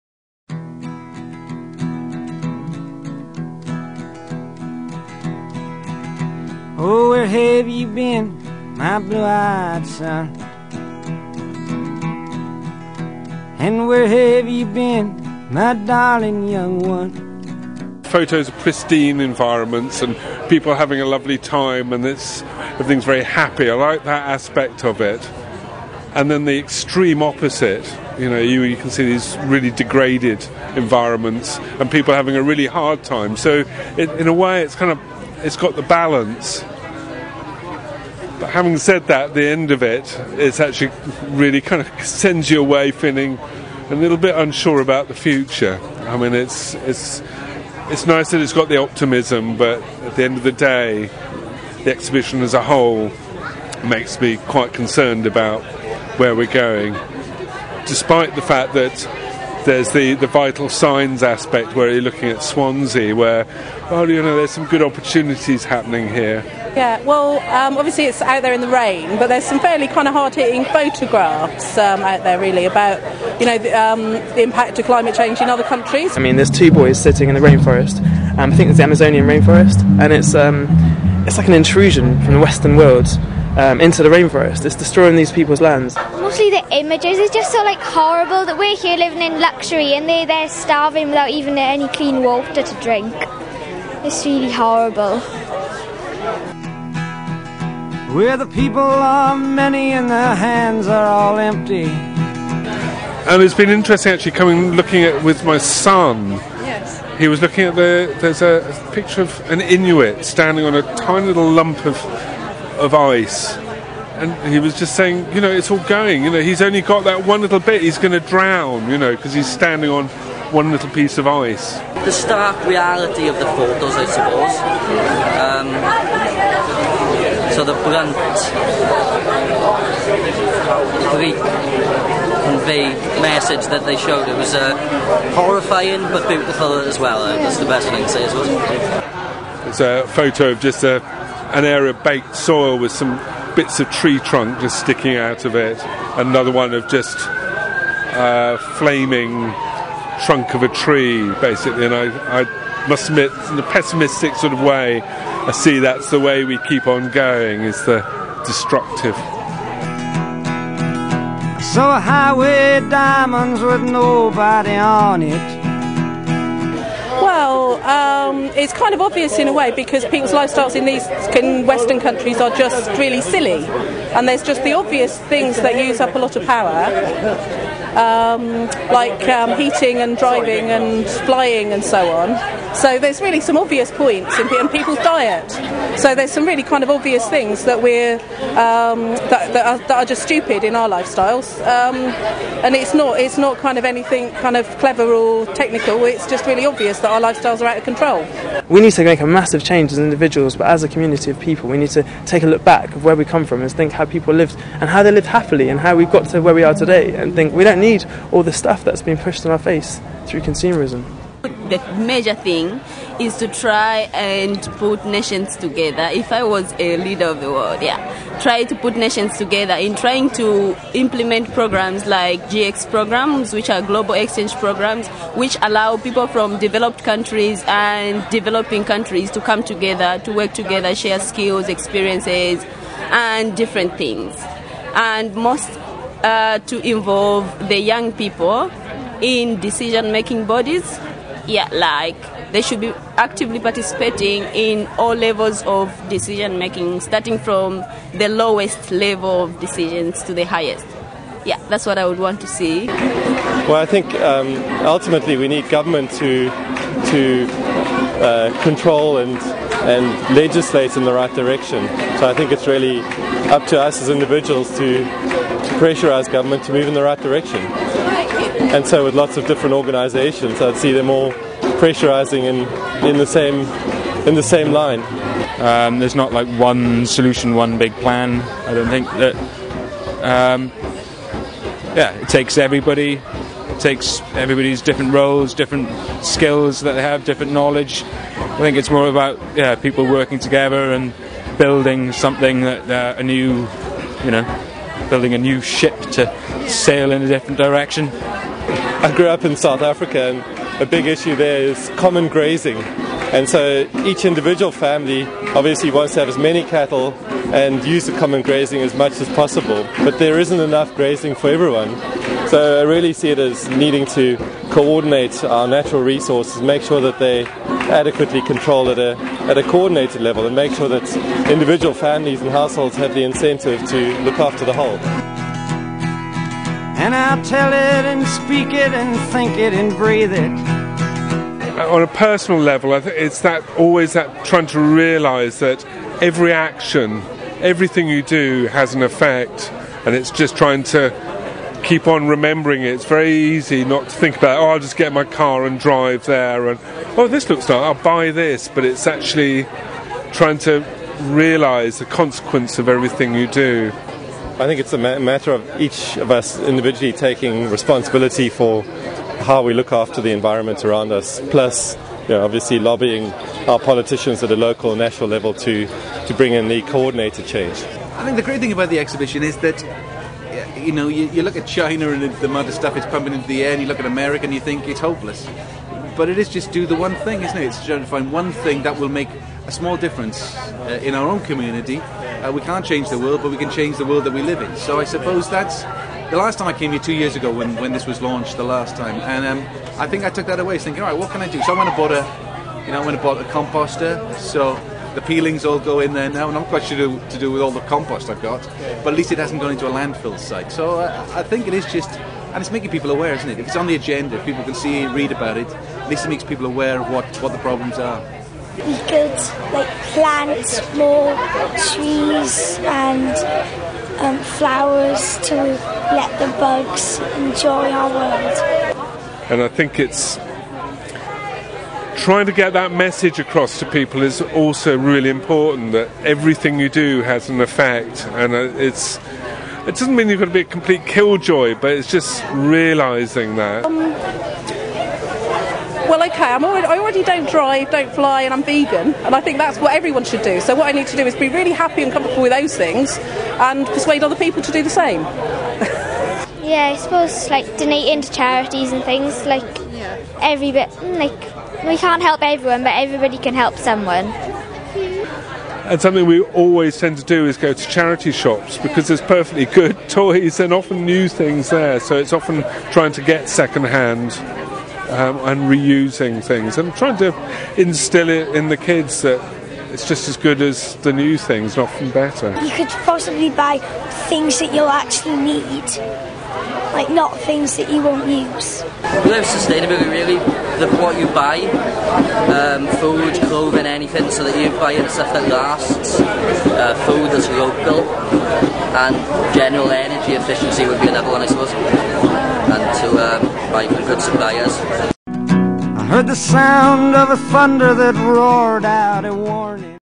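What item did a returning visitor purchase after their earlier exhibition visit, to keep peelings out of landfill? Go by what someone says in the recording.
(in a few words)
A composter.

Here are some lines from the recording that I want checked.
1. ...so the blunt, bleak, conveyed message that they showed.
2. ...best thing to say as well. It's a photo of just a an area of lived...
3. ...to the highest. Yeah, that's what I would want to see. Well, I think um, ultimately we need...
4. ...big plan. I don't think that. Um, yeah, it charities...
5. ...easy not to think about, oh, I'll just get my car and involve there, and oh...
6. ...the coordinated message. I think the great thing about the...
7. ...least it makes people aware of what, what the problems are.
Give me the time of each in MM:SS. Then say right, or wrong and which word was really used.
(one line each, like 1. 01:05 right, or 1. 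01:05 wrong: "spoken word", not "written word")
1. 02:07 right
2. 02:17 wrong: "baked", not "lived"
3. 04:10 right
4. 04:37 wrong: "takes", not "charities"
5. 05:43 wrong: "drive", not "involve"
6. 06:06 wrong: "change", not "message"
7. 06:46 right.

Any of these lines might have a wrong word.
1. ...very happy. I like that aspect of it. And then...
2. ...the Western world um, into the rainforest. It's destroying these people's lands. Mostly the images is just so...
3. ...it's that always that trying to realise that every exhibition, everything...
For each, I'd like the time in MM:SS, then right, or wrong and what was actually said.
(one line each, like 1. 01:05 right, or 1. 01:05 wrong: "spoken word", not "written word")
1. 00:23 right
2. 01:22 right
3. 05:32 wrong: "action", not "exhibition".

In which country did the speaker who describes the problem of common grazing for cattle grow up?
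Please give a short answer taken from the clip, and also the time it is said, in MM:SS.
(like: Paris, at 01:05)
South Africa, at 04:59.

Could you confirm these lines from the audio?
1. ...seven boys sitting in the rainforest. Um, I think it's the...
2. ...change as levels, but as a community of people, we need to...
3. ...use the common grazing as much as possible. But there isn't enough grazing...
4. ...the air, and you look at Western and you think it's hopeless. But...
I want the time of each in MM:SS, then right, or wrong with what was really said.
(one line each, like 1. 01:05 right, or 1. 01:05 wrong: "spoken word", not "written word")
1. 01:16 wrong: "two", not "seven"
2. 03:19 wrong: "individuals", not "levels"
3. 05:07 right
4. 06:13 wrong: "America", not "Western".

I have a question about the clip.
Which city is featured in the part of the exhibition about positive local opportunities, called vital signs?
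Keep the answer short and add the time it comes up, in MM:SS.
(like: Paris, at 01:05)
Swansea, at 01:02.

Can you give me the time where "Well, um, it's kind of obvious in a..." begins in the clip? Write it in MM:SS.
02:47.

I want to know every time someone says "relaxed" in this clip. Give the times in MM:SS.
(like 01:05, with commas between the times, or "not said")
not said.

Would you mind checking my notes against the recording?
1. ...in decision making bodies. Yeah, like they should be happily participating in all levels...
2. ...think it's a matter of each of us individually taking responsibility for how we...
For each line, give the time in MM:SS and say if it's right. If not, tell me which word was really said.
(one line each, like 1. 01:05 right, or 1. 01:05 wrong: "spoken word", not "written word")
1. 03:59 wrong: "actively", not "happily"
2. 05:54 right.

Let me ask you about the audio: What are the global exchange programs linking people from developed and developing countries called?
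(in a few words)
GX.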